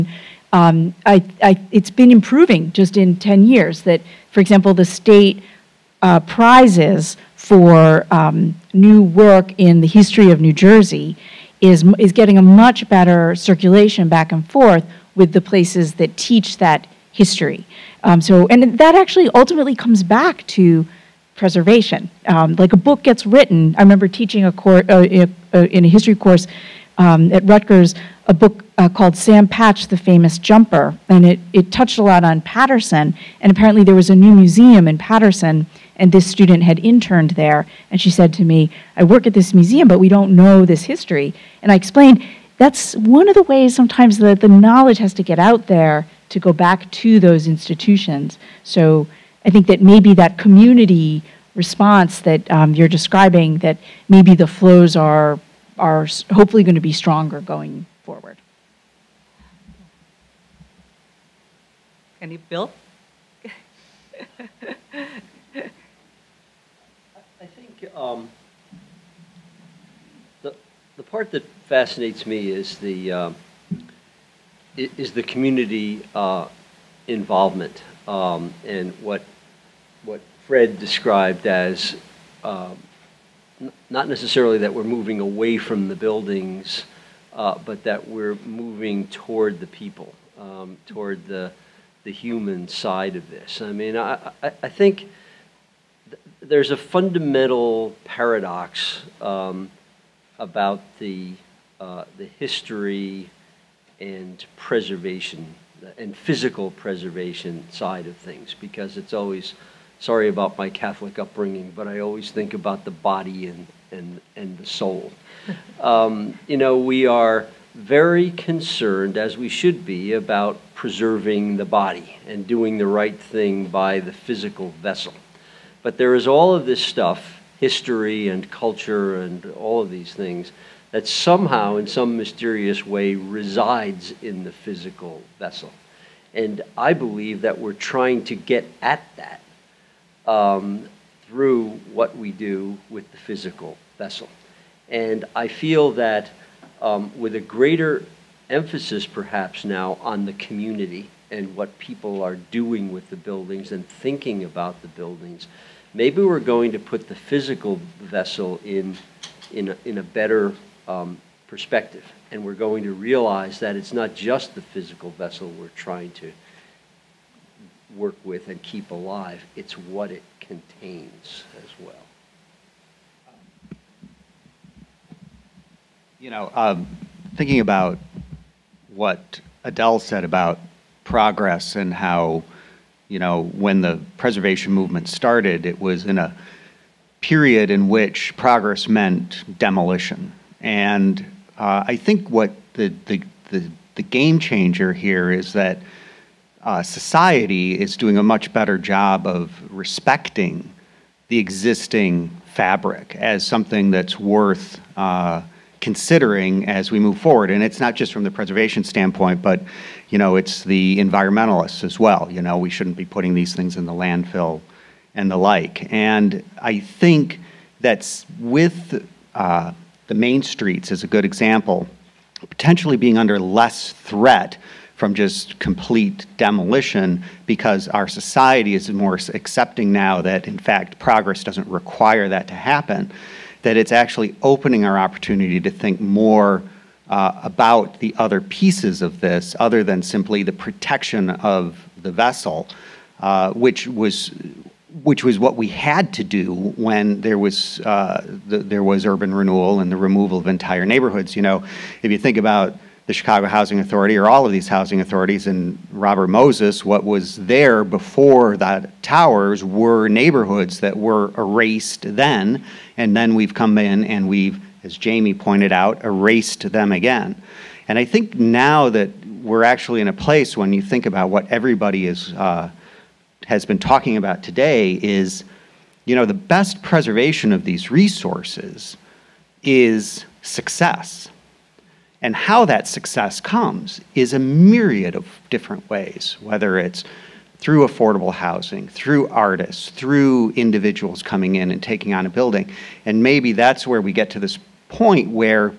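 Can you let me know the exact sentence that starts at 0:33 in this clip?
And apparently, there was a new museum in Paterson, and this student had interned there.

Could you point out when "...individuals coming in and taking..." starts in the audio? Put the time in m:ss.
4:50.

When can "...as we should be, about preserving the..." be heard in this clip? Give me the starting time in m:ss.
1:59.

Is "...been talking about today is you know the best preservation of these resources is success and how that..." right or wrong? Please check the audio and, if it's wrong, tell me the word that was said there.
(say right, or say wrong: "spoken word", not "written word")
right.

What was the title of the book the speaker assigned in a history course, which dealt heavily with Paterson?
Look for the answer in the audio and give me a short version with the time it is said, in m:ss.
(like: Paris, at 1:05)
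Sam Patch, the Famous Jumper, at 0:29.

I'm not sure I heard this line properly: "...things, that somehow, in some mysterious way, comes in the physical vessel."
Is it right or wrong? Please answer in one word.
wrong.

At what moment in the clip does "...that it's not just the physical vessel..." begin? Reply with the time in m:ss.
2:43.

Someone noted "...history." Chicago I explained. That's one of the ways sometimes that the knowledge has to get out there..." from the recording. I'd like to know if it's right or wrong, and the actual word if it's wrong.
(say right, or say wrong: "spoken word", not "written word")
wrong: "And", not "Chicago".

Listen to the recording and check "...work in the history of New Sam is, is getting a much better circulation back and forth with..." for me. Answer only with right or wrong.
wrong.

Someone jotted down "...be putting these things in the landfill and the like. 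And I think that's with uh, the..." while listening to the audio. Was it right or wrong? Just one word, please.
right.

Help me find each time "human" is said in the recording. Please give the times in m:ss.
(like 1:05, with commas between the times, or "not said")
1:32.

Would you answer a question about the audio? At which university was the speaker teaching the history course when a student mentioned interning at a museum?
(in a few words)
Rutgers.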